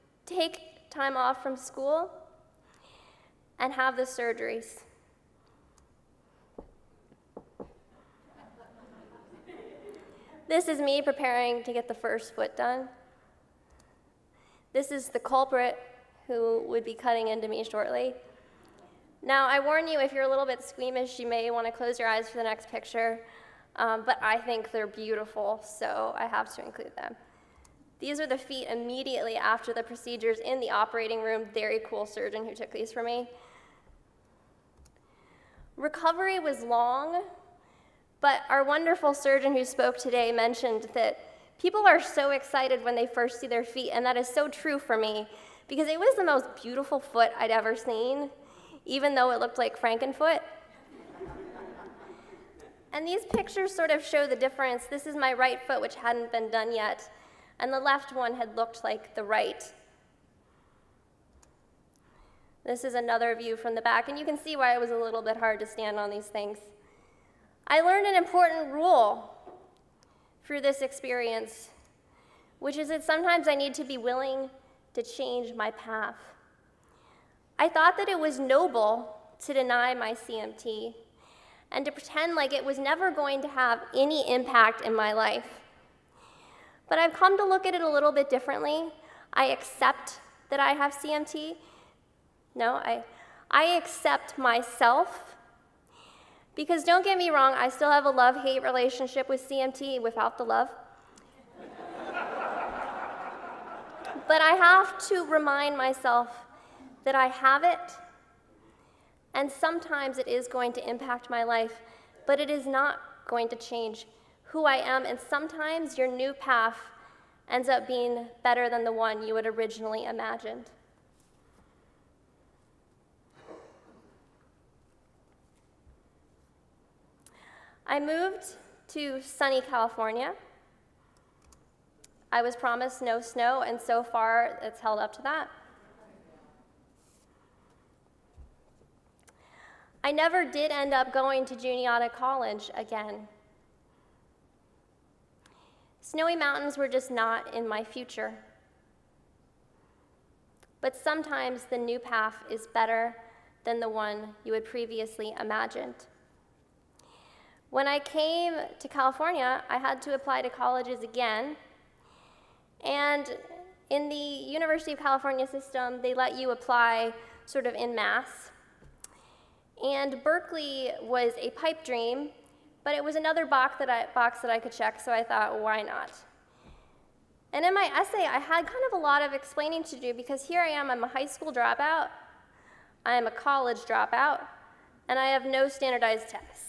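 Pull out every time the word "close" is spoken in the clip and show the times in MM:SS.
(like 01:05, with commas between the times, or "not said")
00:21.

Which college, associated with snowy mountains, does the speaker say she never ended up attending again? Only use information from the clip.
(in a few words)
Juniata College.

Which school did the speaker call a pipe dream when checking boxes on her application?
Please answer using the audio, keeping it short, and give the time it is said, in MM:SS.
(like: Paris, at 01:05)
Berkeley, at 02:50.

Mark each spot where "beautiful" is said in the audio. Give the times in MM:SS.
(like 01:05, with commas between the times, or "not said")
00:24, 00:46.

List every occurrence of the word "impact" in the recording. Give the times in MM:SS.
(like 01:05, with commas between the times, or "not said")
01:24, 01:50.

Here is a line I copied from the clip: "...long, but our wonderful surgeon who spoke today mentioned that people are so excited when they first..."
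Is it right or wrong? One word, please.
right.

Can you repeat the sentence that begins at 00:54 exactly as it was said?
This is my right foot, which hadn't been done yet, and the left one had looked like the right.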